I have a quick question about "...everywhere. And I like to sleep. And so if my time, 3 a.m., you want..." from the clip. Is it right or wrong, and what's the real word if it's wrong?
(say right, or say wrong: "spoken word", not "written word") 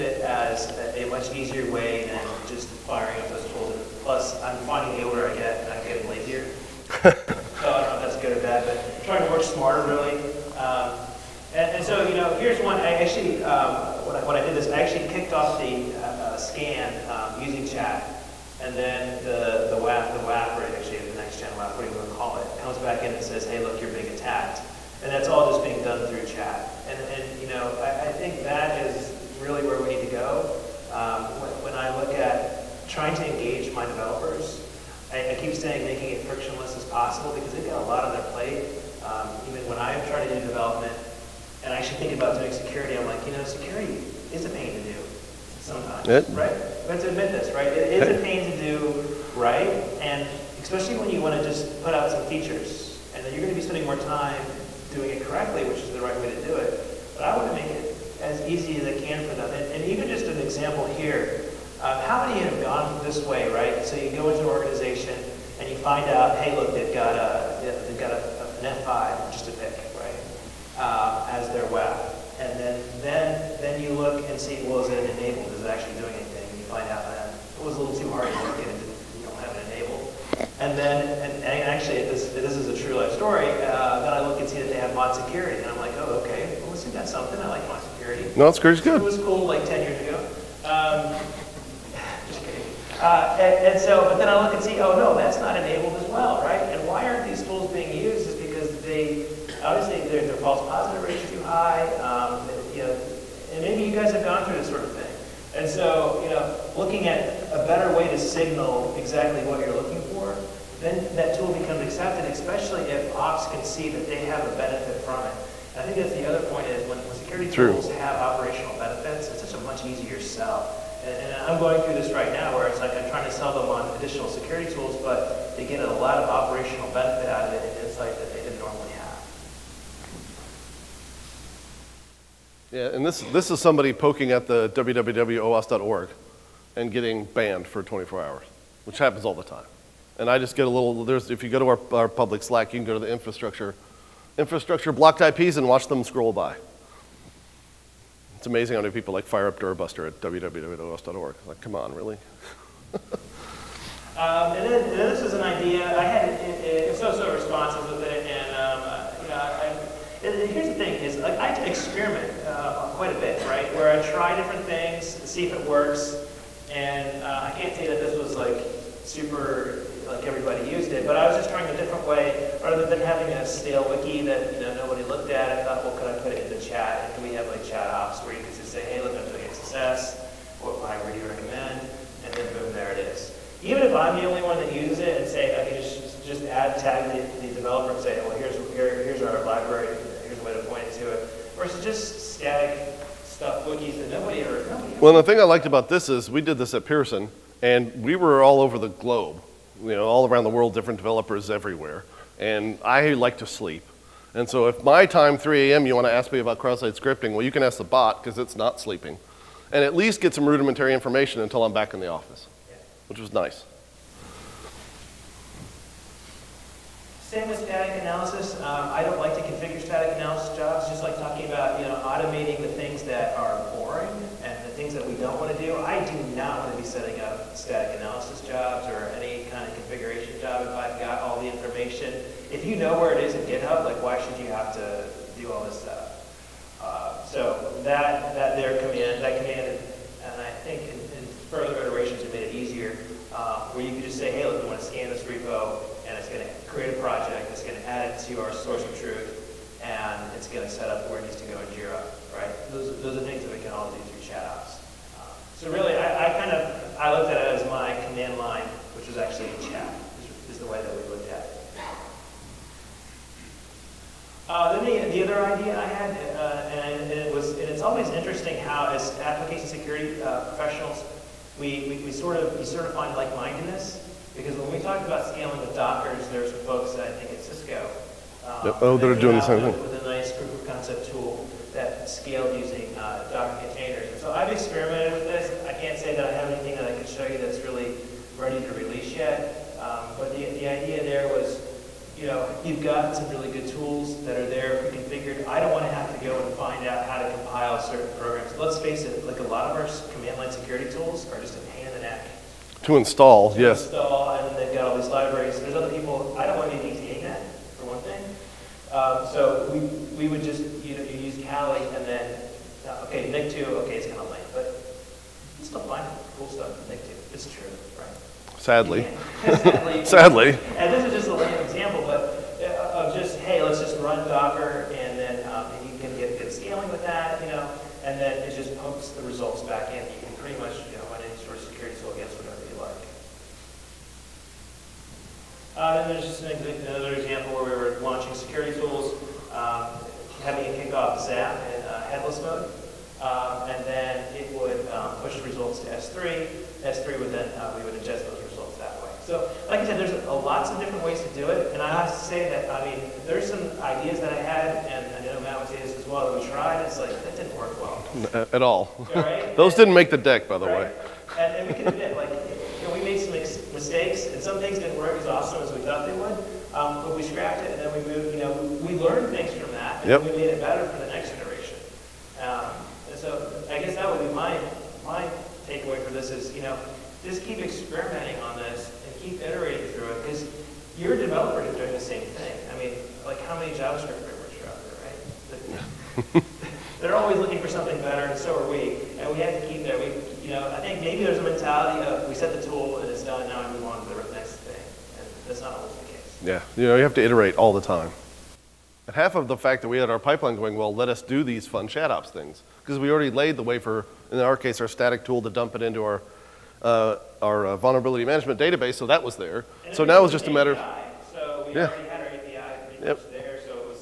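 right.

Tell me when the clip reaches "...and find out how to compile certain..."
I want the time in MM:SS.
04:56.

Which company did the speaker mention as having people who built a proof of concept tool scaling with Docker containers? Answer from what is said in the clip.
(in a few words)
Cisco.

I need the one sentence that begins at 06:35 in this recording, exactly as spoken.
And that's not always the case.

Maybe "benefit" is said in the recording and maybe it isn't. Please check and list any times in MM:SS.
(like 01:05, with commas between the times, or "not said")
01:54, 01:58, 02:06.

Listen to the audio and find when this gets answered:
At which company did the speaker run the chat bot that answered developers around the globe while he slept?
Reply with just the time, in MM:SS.
03:16.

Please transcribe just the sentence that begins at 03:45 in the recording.
I do not want to be setting up static analysis jobs or if I've got all the information.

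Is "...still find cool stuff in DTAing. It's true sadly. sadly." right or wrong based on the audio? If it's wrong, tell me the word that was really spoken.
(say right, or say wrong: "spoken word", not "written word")
wrong: "Nikto", not "DTAing".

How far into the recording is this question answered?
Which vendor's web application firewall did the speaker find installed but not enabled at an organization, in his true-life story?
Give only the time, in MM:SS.
01:08.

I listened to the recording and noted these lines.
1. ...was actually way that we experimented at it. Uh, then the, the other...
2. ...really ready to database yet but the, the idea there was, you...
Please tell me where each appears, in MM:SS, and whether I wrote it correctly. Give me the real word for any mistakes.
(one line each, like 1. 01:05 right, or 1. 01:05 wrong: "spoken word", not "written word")
1. 04:19 wrong: "looked", not "experimented"
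2. 04:47 wrong: "release", not "database".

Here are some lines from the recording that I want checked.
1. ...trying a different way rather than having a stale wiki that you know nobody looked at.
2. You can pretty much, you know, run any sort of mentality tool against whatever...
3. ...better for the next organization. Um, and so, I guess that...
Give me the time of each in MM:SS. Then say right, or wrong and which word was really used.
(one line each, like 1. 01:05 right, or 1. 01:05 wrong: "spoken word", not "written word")
1. 02:51 right
2. 05:30 wrong: "security", not "mentality"
3. 06:10 wrong: "generation", not "organization".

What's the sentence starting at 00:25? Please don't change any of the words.
And that's all just being done through chat.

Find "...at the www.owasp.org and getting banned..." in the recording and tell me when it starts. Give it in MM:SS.
02:14.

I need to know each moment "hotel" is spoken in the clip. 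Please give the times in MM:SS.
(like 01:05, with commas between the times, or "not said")
not said.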